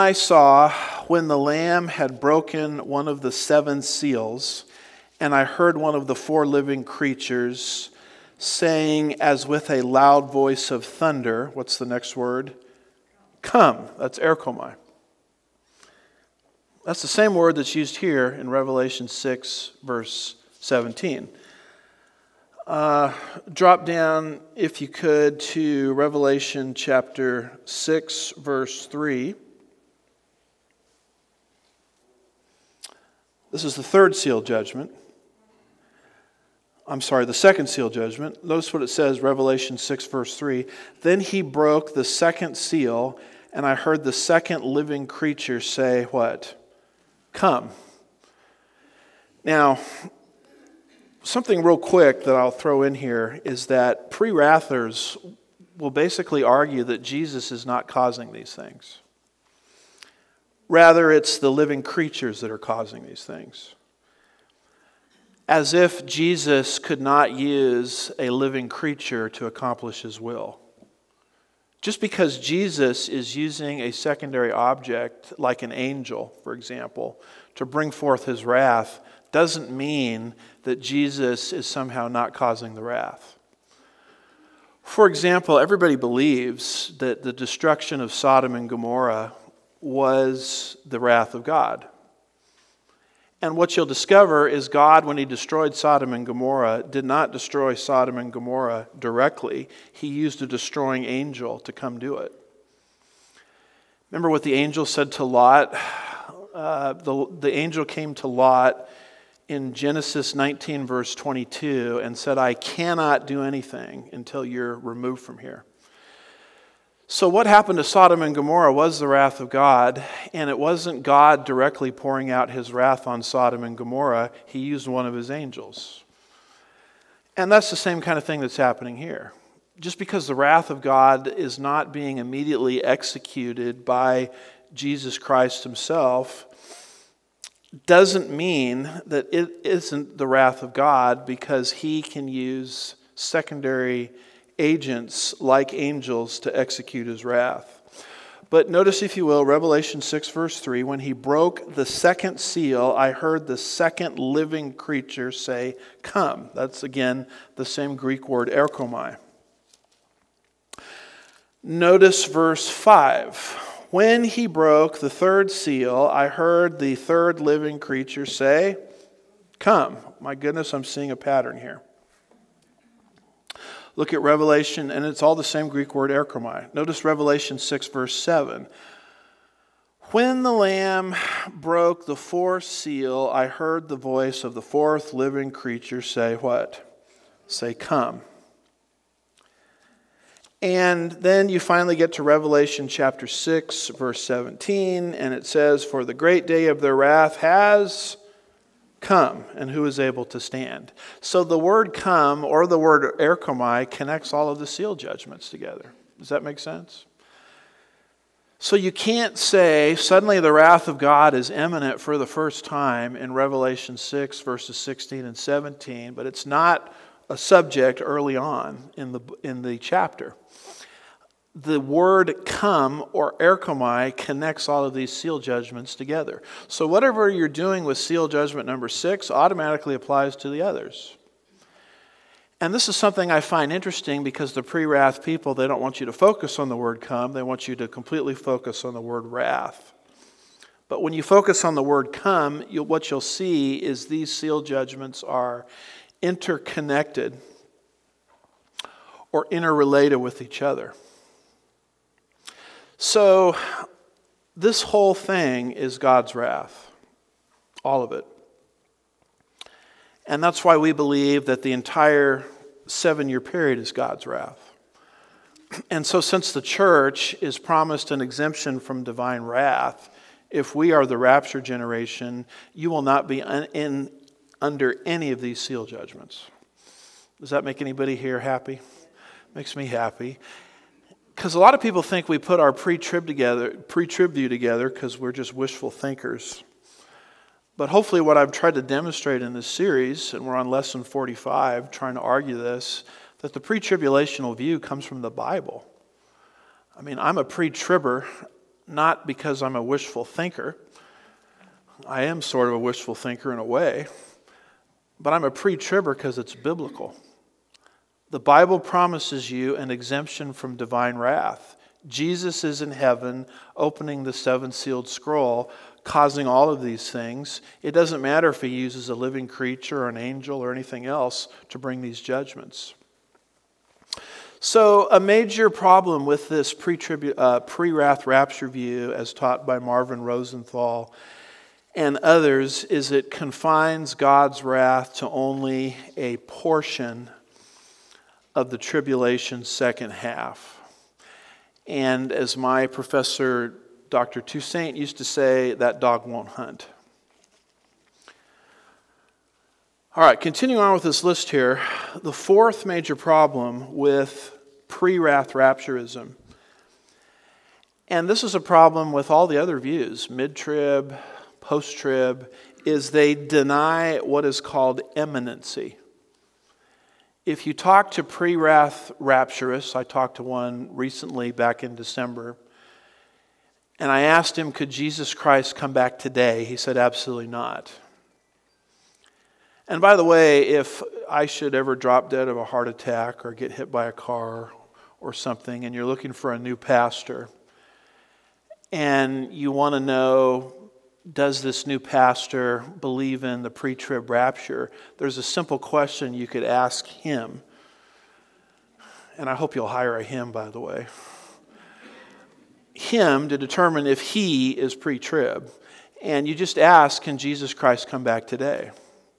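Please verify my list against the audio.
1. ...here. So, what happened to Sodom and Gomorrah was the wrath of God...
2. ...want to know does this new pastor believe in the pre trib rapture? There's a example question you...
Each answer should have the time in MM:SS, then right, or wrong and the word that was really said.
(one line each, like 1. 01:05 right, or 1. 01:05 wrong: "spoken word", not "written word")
1. 01:55 right
2. 06:29 wrong: "simple", not "example".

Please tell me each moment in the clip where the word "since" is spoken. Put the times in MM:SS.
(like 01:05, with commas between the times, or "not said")
04:26.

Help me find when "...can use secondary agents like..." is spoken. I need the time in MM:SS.
02:22.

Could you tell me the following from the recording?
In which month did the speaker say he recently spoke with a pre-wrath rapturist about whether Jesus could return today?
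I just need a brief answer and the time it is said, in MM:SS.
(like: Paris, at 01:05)
December, at 06:11.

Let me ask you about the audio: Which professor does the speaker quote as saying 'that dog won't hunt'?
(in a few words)
Dr. Toussaint.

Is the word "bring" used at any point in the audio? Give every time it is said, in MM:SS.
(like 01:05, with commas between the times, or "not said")
01:17, 05:21.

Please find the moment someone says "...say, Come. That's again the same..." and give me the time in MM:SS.
02:35.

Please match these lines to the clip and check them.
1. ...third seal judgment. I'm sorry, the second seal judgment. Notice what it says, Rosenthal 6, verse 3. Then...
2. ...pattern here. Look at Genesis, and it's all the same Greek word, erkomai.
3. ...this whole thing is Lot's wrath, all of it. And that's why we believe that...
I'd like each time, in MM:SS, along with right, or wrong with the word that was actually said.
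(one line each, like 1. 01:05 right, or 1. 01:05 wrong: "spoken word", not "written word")
1. 00:33 wrong: "Revelation", not "Rosenthal"
2. 02:51 wrong: "Revelation", not "Genesis"
3. 04:14 wrong: "God", not "Lot".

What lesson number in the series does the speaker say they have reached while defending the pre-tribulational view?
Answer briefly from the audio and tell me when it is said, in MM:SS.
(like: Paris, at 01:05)
45, at 04:50.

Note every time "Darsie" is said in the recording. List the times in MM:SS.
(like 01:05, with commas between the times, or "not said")
not said.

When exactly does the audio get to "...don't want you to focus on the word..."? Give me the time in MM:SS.
03:55.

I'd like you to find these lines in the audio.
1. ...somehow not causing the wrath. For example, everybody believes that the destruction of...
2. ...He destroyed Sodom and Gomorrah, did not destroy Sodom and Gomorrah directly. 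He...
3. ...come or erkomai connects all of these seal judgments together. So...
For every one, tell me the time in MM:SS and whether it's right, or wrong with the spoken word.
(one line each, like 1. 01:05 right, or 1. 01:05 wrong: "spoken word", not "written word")
1. 01:21 right
2. 01:35 right
3. 03:42 right.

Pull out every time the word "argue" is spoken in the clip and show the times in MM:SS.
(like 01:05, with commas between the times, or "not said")
00:56, 04:52.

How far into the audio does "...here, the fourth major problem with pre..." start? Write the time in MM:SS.
05:51.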